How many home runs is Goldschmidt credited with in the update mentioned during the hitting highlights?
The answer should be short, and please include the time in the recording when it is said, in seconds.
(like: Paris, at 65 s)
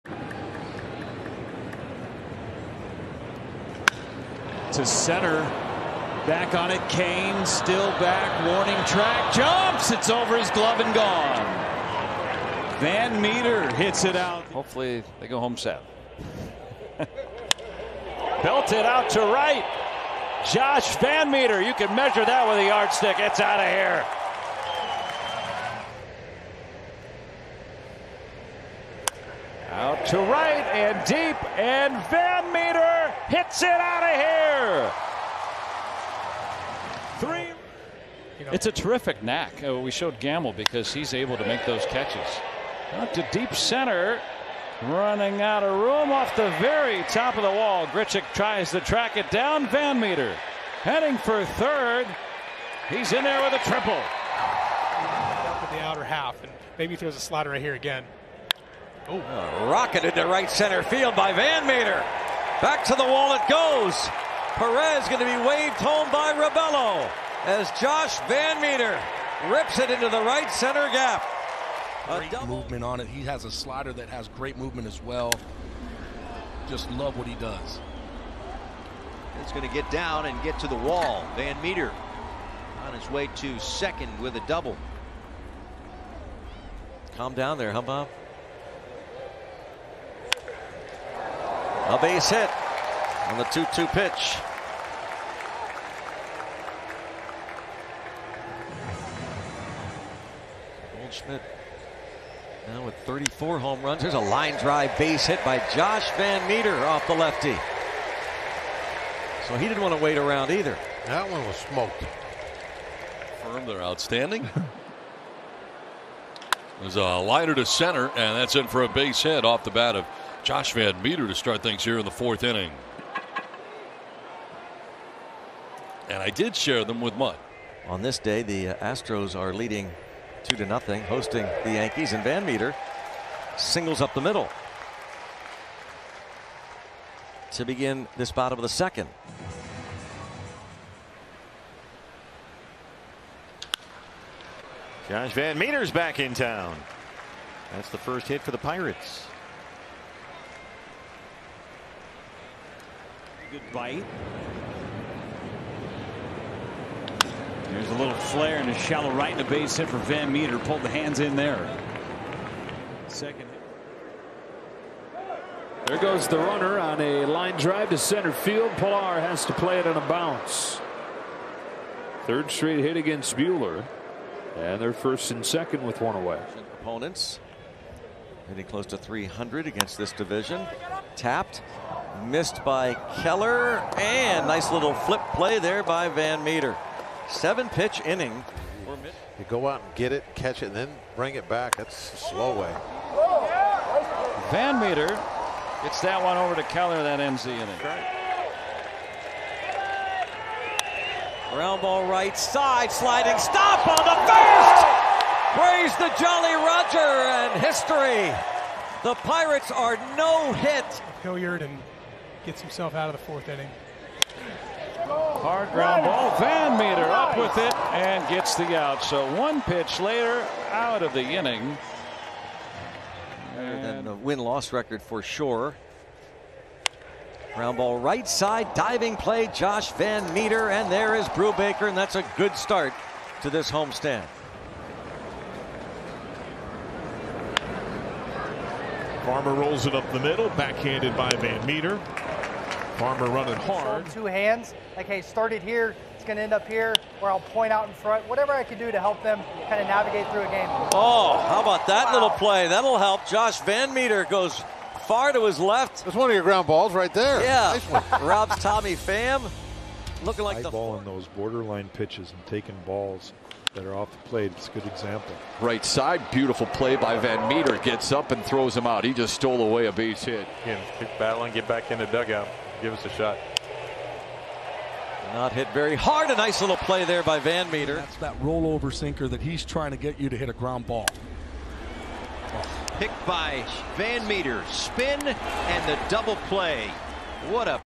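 34, at 103 s.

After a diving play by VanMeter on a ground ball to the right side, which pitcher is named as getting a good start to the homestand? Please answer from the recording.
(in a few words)
Brubaker.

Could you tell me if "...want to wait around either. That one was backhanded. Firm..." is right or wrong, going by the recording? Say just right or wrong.
wrong.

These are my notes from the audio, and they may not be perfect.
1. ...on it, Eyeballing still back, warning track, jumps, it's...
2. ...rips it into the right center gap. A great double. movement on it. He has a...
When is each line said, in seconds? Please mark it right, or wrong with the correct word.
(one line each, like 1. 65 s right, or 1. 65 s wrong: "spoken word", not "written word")
1. 6 s wrong: "Kane", not "Eyeballing"
2. 69 s right.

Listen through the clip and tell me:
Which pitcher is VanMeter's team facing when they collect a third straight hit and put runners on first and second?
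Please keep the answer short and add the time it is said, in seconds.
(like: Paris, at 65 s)
Buehler, at 173 s.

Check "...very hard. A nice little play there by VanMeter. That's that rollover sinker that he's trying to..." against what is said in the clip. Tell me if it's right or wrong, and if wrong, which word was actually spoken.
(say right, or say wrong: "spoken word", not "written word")
right.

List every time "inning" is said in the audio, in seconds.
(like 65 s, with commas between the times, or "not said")
122 s, 188 s, 197 s, 213 s, 221 s.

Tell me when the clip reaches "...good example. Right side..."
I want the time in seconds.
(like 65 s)
264 s.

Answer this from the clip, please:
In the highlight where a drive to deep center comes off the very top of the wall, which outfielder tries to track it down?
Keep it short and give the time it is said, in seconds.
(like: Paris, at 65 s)
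Grichuk, at 47 s.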